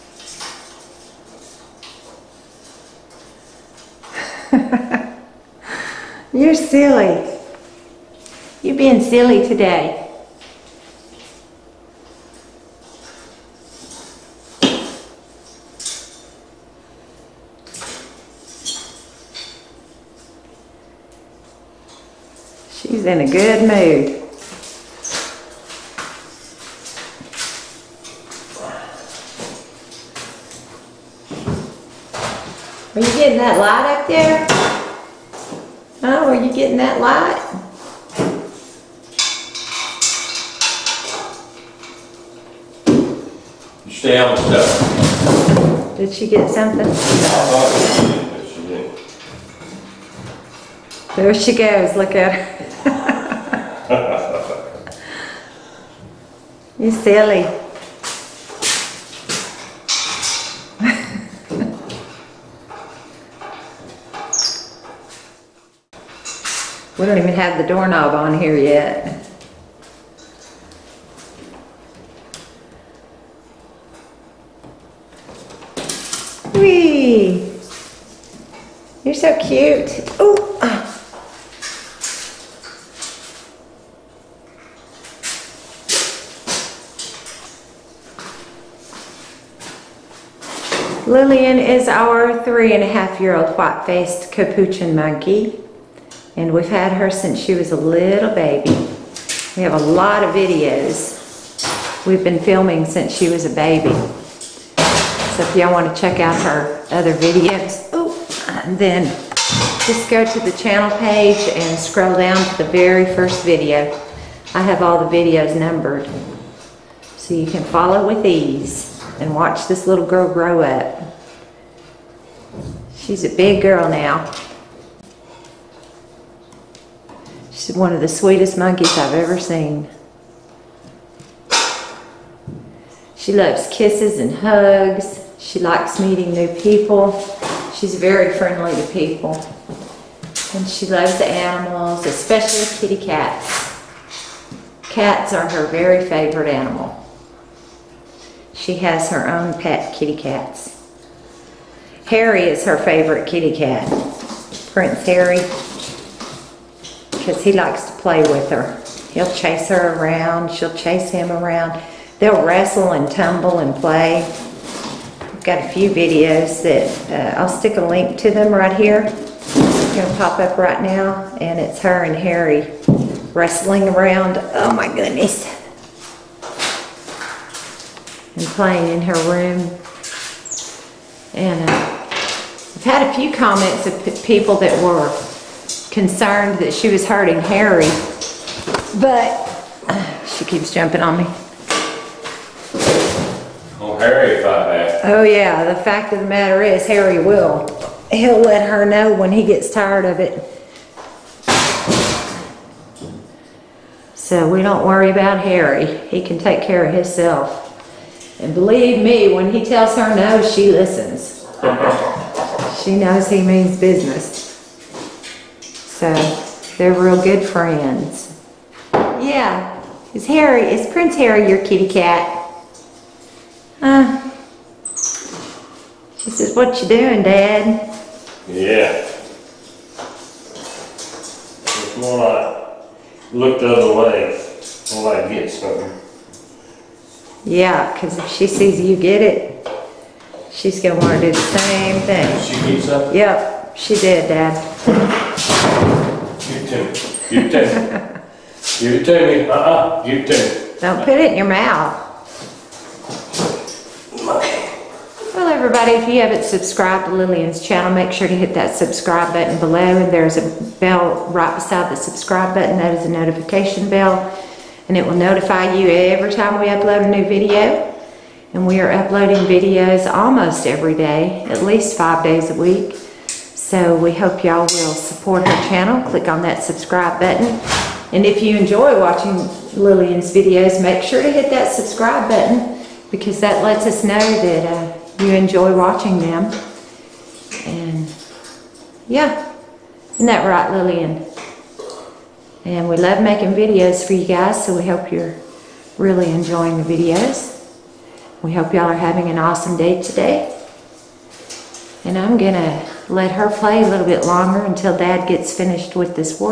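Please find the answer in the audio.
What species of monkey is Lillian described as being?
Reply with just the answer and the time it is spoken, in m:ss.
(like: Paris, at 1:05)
White faced capuchin, at 1:33.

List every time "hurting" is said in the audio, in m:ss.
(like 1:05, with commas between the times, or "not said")
3:07.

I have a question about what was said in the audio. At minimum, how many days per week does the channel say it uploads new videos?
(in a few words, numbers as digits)
5.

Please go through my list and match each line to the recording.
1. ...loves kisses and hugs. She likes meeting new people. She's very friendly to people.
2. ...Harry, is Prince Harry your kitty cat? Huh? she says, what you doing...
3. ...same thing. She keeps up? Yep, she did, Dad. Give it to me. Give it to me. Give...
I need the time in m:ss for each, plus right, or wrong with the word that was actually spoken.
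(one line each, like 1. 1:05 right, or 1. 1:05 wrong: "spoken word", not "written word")
1. 2:13 right
2. 3:40 right
3. 4:01 right.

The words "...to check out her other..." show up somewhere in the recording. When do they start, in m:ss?
1:45.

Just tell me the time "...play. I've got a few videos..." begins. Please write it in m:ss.
2:43.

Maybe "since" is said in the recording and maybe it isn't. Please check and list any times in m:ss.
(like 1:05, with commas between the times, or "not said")
1:37, 1:42.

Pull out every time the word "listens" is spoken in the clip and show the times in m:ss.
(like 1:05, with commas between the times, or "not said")
3:30.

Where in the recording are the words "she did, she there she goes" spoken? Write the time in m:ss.
0:46.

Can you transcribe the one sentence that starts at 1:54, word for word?
I have all the videos numbered.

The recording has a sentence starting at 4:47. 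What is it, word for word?
And yeah, isn't that right, Lillian?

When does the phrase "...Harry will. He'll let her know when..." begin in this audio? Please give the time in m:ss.
3:16.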